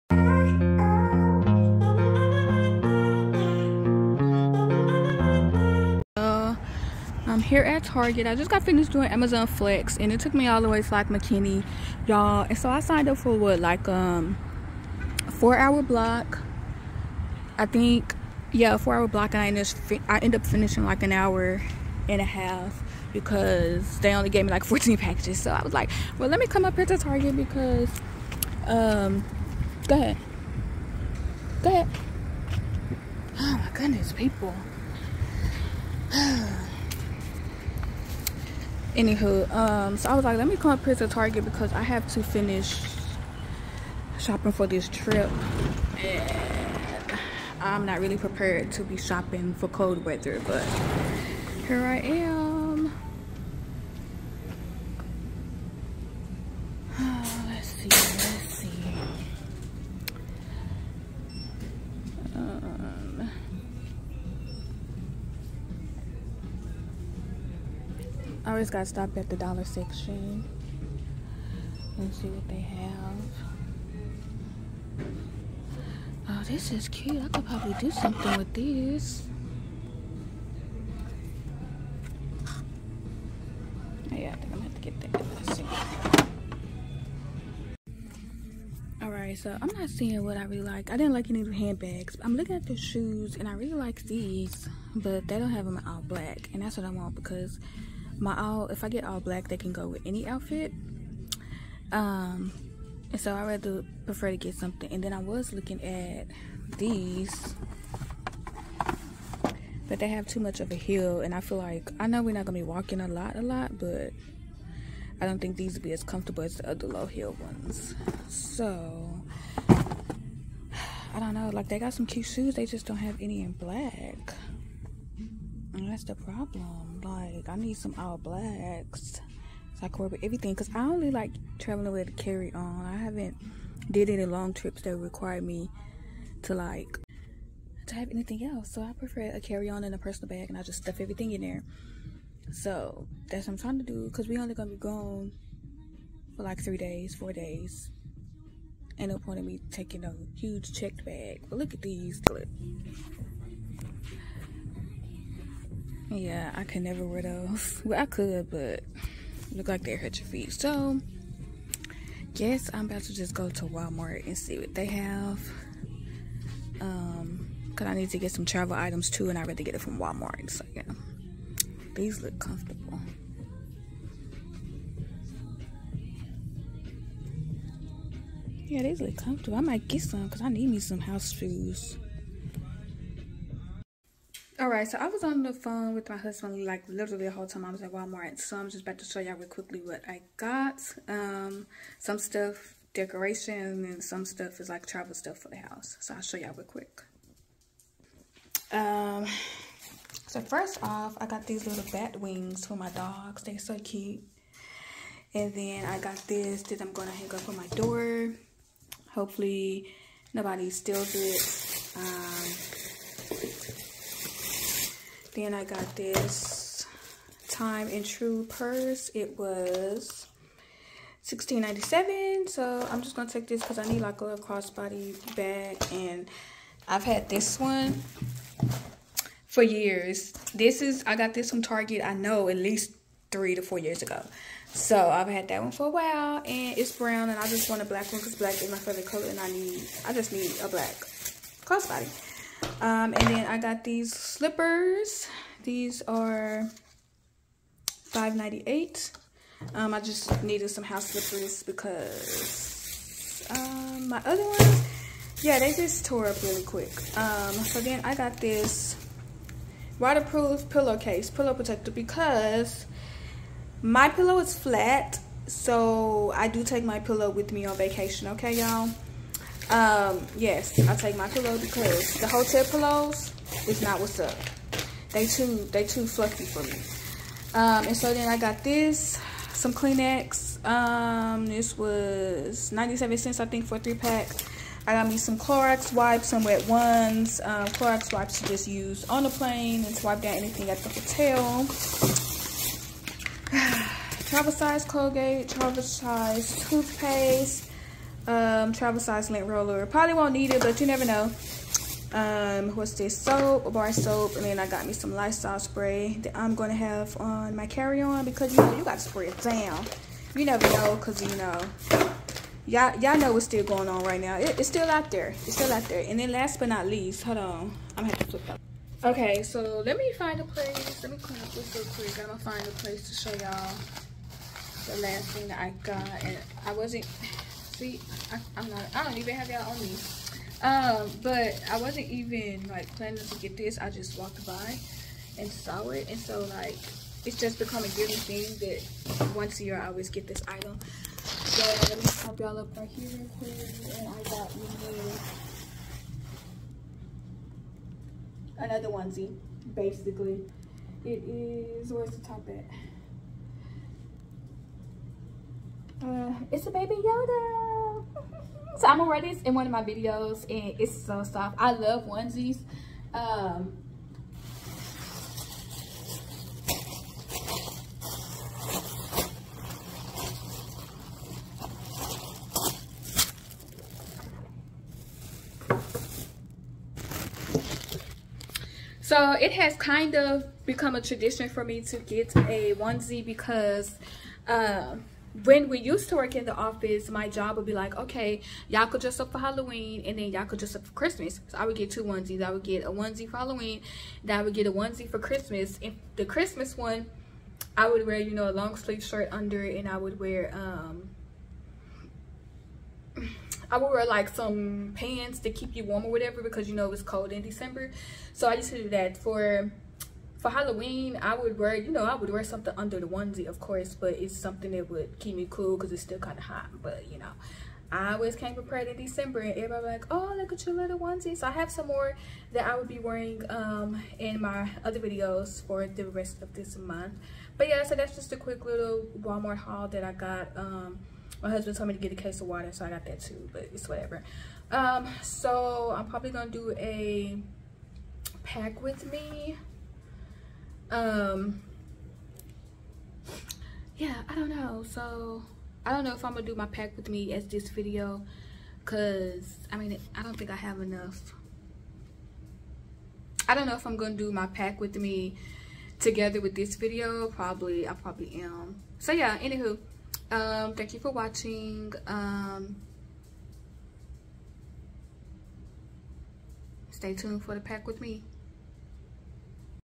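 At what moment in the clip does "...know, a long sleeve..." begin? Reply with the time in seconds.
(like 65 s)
398 s.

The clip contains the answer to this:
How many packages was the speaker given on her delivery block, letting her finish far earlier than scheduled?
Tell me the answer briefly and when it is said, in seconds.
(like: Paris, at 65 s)
14, at 24 s.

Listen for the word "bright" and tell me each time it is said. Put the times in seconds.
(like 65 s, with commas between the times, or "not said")
not said.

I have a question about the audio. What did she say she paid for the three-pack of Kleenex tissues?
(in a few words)
97 cents.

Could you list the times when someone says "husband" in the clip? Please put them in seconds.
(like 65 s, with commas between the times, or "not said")
186 s, 431 s.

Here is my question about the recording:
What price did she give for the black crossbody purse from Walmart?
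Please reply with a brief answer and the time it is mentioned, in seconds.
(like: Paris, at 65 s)
$16.97, at 221 s.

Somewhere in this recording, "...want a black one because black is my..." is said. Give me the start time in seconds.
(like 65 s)
237 s.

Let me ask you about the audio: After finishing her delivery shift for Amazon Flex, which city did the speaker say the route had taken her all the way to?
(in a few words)
McKinney.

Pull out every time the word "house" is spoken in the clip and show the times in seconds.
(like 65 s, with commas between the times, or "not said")
180 s, 195 s, 250 s.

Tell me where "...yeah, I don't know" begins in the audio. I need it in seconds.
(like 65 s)
443 s.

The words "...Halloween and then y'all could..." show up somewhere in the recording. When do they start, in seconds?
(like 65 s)
389 s.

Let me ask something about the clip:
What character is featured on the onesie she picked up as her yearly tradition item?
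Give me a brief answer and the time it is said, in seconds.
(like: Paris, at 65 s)
Baby Yoda, at 356 s.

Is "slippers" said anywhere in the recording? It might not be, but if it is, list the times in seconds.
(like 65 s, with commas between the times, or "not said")
244 s, 251 s.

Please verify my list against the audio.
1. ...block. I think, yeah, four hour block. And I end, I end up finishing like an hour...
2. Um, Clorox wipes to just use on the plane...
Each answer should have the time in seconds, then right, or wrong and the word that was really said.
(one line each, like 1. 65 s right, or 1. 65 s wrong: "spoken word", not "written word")
1. 15 s right
2. 287 s right.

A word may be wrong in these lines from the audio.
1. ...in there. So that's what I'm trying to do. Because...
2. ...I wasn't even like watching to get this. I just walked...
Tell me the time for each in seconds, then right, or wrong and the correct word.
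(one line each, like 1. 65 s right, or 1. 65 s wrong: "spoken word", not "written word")
1. 141 s right
2. 331 s wrong: "planning", not "watching".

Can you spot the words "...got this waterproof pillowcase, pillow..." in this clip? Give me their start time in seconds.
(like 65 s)
258 s.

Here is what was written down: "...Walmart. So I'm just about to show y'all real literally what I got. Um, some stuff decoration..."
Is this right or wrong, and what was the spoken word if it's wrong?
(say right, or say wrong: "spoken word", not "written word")
wrong: "quickly", not "literally".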